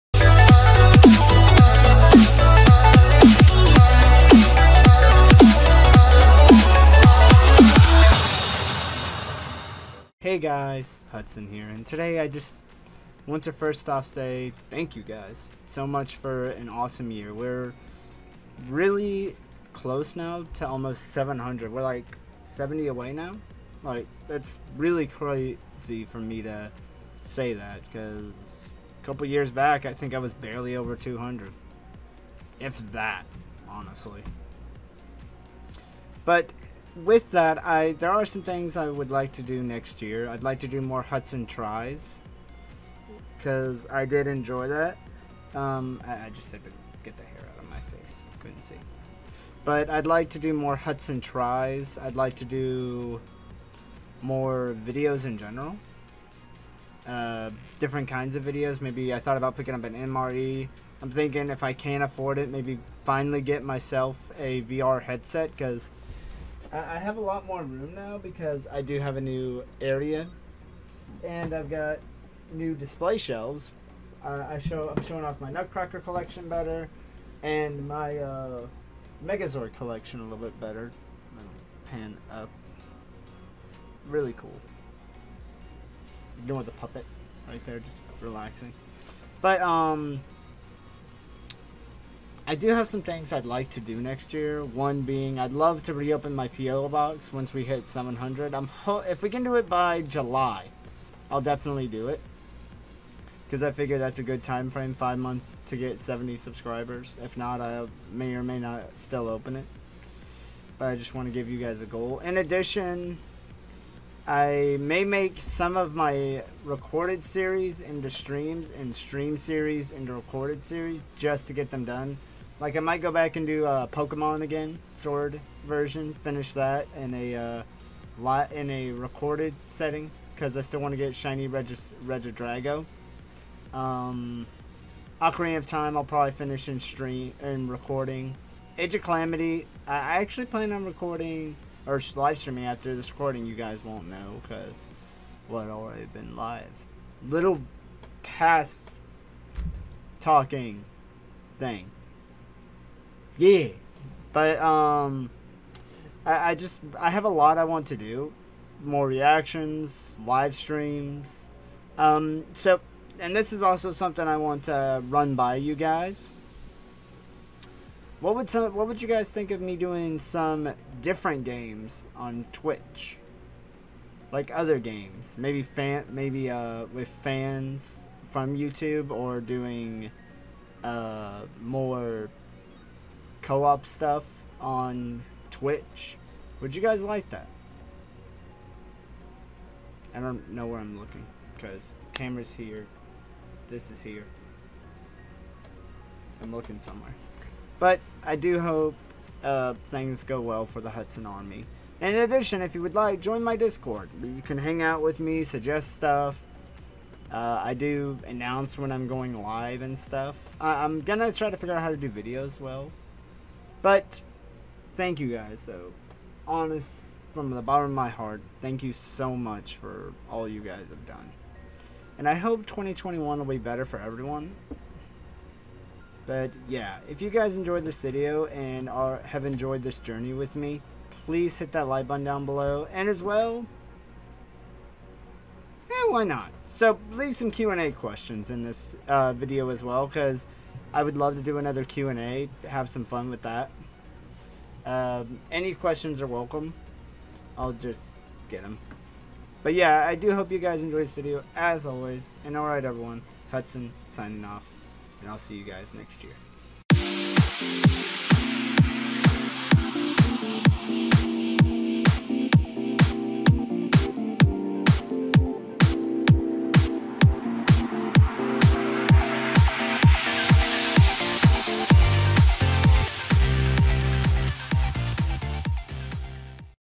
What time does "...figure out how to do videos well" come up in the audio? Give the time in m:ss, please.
3:31.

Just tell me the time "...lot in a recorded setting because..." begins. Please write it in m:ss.
2:08.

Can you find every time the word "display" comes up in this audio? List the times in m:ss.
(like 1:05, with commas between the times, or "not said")
1:12.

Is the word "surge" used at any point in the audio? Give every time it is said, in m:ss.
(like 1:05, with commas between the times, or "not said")
not said.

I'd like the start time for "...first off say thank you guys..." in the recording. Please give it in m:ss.
0:13.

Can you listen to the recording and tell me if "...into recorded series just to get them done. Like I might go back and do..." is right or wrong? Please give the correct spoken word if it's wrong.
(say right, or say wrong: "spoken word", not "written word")
right.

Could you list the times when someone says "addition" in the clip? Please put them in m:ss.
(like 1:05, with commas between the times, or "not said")
1:52, 3:22.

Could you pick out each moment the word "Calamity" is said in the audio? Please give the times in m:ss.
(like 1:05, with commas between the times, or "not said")
2:19.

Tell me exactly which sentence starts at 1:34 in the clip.
One being, I'd love to reopen my PO box once we hit 700.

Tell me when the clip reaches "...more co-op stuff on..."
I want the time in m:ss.
3:01.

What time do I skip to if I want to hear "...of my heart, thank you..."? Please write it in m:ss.
3:37.